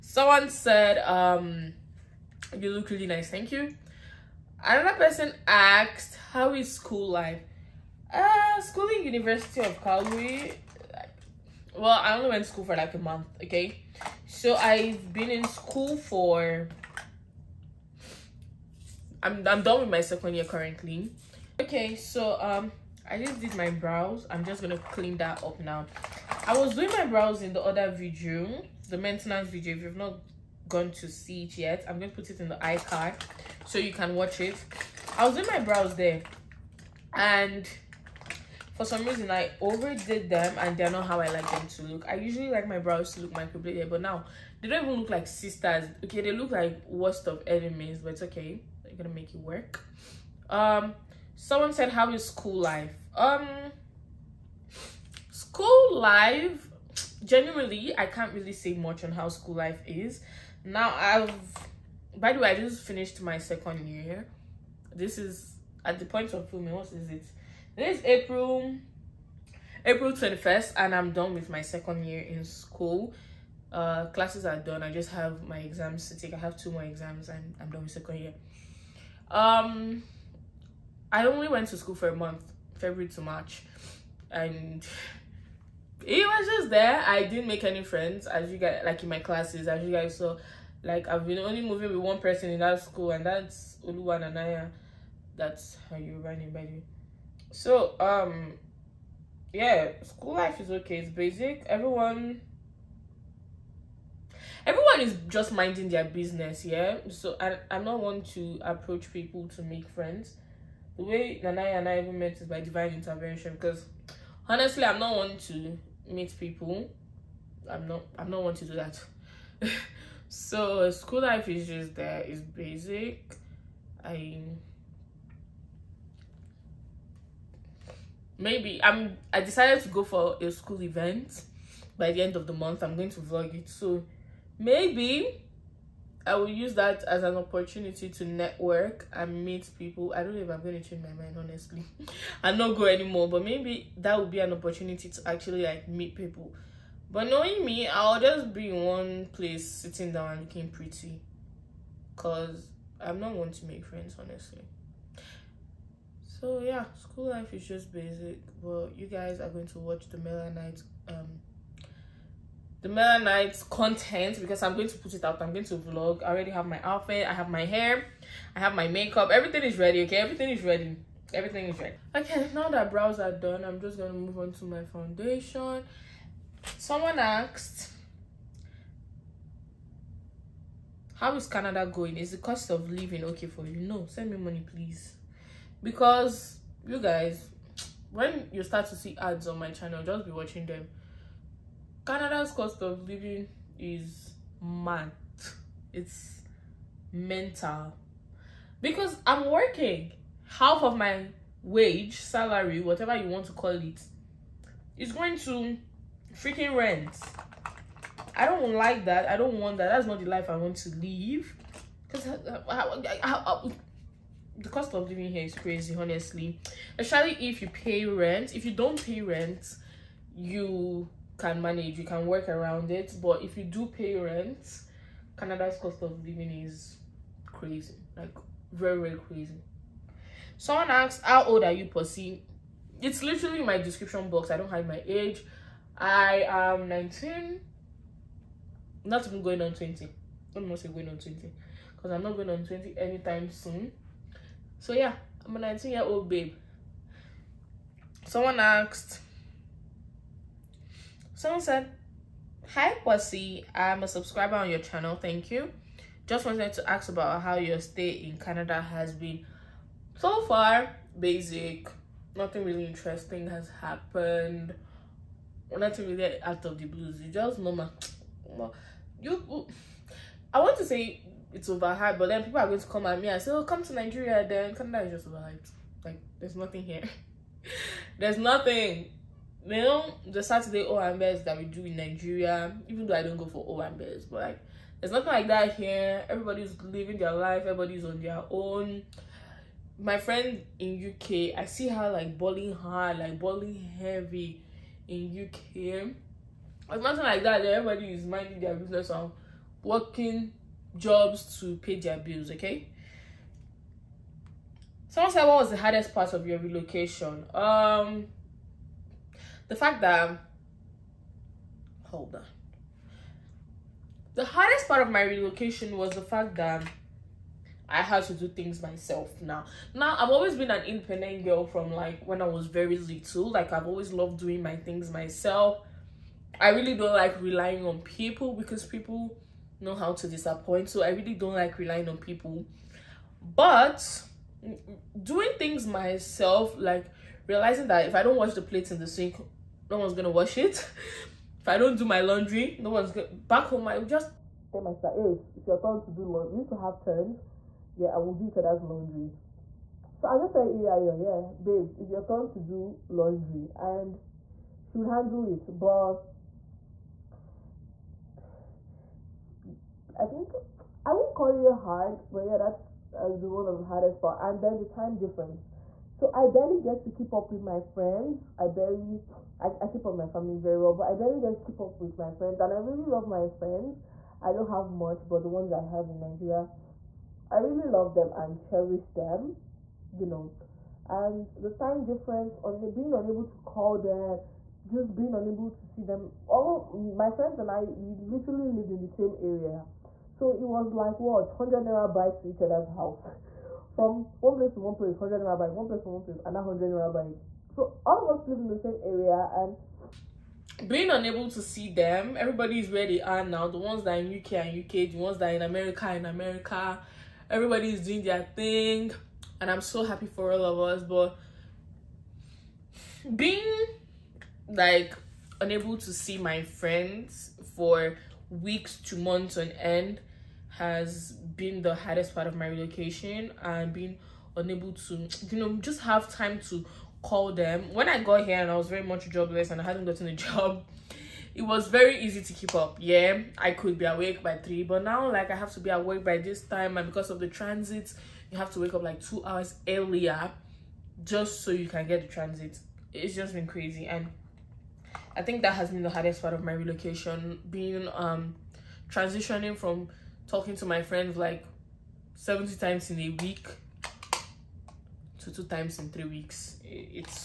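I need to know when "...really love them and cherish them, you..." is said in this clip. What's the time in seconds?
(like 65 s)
377 s.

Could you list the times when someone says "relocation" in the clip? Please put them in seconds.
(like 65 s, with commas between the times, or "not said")
306 s, 315 s, 422 s, 446 s.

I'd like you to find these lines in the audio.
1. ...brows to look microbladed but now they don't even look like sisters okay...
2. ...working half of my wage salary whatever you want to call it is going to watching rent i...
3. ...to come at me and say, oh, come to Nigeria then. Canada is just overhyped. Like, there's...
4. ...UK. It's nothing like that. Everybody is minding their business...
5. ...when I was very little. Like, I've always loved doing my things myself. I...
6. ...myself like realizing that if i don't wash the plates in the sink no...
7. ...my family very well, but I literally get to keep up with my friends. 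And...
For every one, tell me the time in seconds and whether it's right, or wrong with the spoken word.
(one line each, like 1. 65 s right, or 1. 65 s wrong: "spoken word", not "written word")
1. 42 s right
2. 199 s wrong: "freaking", not "watching"
3. 272 s right
4. 295 s right
5. 322 s right
6. 335 s right
7. 370 s wrong: "barely", not "literally".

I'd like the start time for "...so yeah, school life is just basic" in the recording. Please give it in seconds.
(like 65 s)
156 s.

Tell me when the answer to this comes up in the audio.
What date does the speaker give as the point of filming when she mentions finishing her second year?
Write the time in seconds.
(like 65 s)
69 s.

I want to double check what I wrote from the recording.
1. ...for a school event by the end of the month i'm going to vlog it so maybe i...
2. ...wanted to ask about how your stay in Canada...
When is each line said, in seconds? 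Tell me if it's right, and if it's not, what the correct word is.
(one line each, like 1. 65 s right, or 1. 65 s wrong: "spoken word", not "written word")
1. 130 s right
2. 256 s right.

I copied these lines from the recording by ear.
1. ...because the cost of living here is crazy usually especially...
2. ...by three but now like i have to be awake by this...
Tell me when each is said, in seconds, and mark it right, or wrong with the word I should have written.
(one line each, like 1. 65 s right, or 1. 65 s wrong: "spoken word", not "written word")
1. 212 s wrong: "honestly", not "usually"
2. 434 s right.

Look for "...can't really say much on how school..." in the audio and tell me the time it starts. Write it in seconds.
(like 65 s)
58 s.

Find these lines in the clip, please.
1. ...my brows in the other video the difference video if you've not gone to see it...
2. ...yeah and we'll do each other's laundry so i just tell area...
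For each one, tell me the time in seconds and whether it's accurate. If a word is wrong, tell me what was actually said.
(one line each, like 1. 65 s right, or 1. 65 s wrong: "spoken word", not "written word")
1. 26 s wrong: "maintenance", not "difference"
2. 347 s right.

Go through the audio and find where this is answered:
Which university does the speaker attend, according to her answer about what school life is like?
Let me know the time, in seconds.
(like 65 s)
9 s.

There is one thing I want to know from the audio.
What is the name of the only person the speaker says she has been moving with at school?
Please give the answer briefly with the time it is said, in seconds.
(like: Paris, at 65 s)
Oluwa Nanaya, at 93 s.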